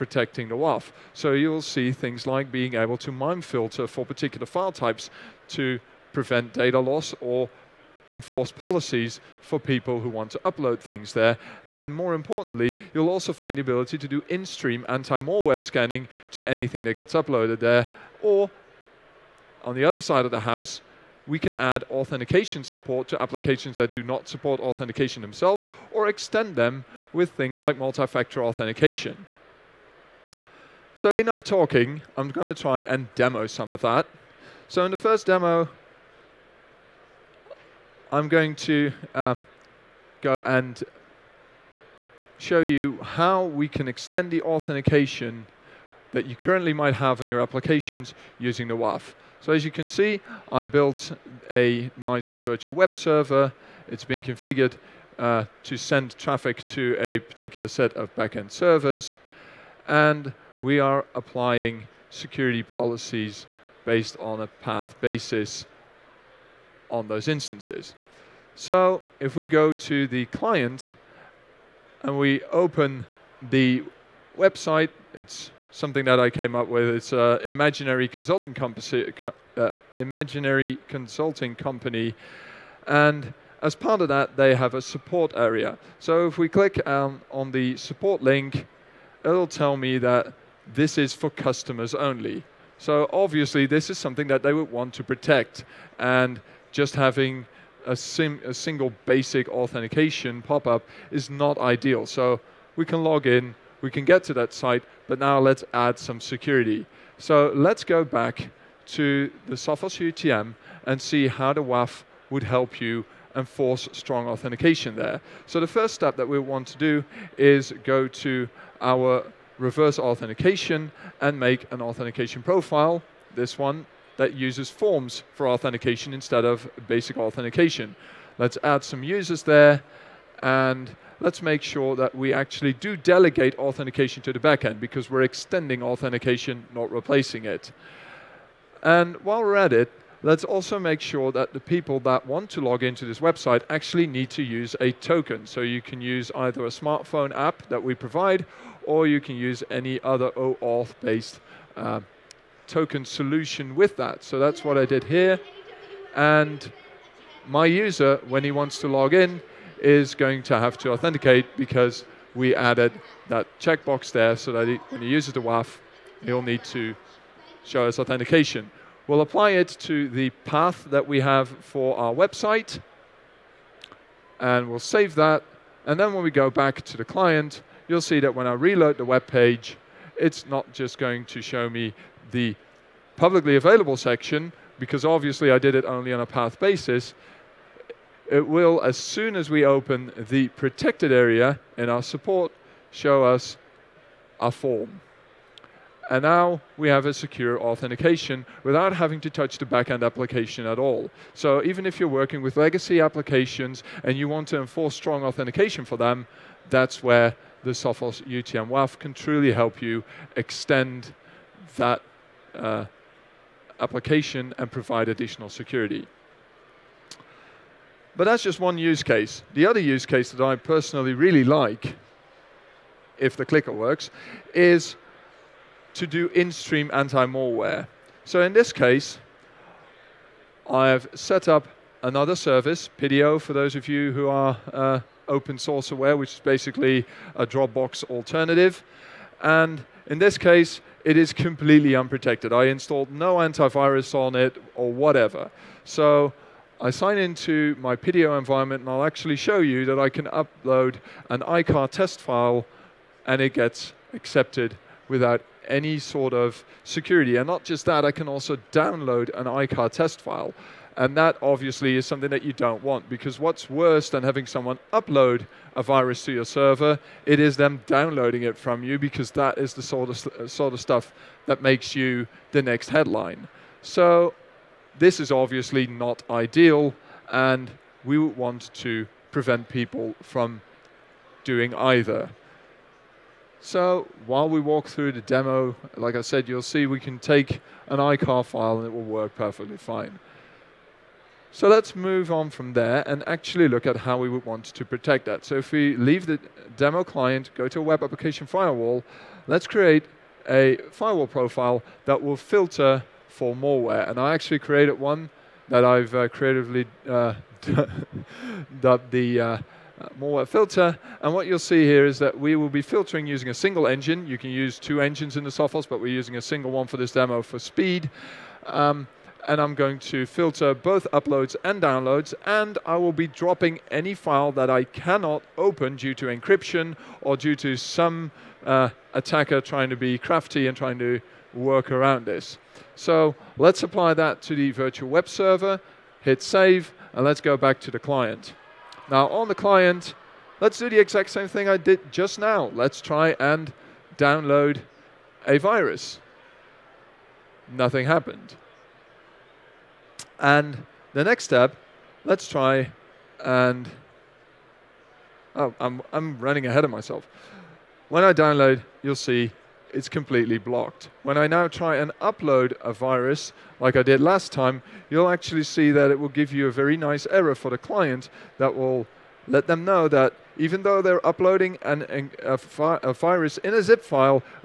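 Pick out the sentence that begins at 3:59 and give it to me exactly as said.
And in this case, it is completely unprotected.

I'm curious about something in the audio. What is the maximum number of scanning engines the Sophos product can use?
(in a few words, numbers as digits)
2.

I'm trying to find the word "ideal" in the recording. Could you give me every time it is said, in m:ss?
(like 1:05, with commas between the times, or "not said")
1:41, 4:36.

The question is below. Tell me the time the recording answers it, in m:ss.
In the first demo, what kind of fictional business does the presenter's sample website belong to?
1:19.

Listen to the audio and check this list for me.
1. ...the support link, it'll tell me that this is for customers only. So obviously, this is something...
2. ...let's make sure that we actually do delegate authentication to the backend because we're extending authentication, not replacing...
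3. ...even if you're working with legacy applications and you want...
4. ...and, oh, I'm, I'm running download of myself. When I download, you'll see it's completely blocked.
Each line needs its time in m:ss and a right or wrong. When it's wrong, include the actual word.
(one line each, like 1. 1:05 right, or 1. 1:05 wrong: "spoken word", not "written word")
1. 1:27 right
2. 2:11 right
3. 3:21 right
4. 5:53 wrong: "ahead", not "download".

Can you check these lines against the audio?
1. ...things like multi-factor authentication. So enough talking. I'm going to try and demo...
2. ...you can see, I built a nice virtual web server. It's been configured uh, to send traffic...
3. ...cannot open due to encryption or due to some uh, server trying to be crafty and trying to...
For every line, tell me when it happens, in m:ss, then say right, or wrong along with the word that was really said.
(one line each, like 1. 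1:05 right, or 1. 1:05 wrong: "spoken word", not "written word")
1. 0:27 right
2. 0:49 right
3. 5:24 wrong: "attacker", not "server".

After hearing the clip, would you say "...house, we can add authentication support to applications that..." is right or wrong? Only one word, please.
right.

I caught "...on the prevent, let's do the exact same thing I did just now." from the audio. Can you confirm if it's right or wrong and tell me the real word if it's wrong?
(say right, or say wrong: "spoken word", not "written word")
wrong: "client", not "prevent".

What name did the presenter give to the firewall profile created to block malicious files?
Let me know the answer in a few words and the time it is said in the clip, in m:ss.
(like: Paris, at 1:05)
Malware filter, at 5:10.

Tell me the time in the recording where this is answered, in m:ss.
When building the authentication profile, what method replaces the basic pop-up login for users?
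2:04.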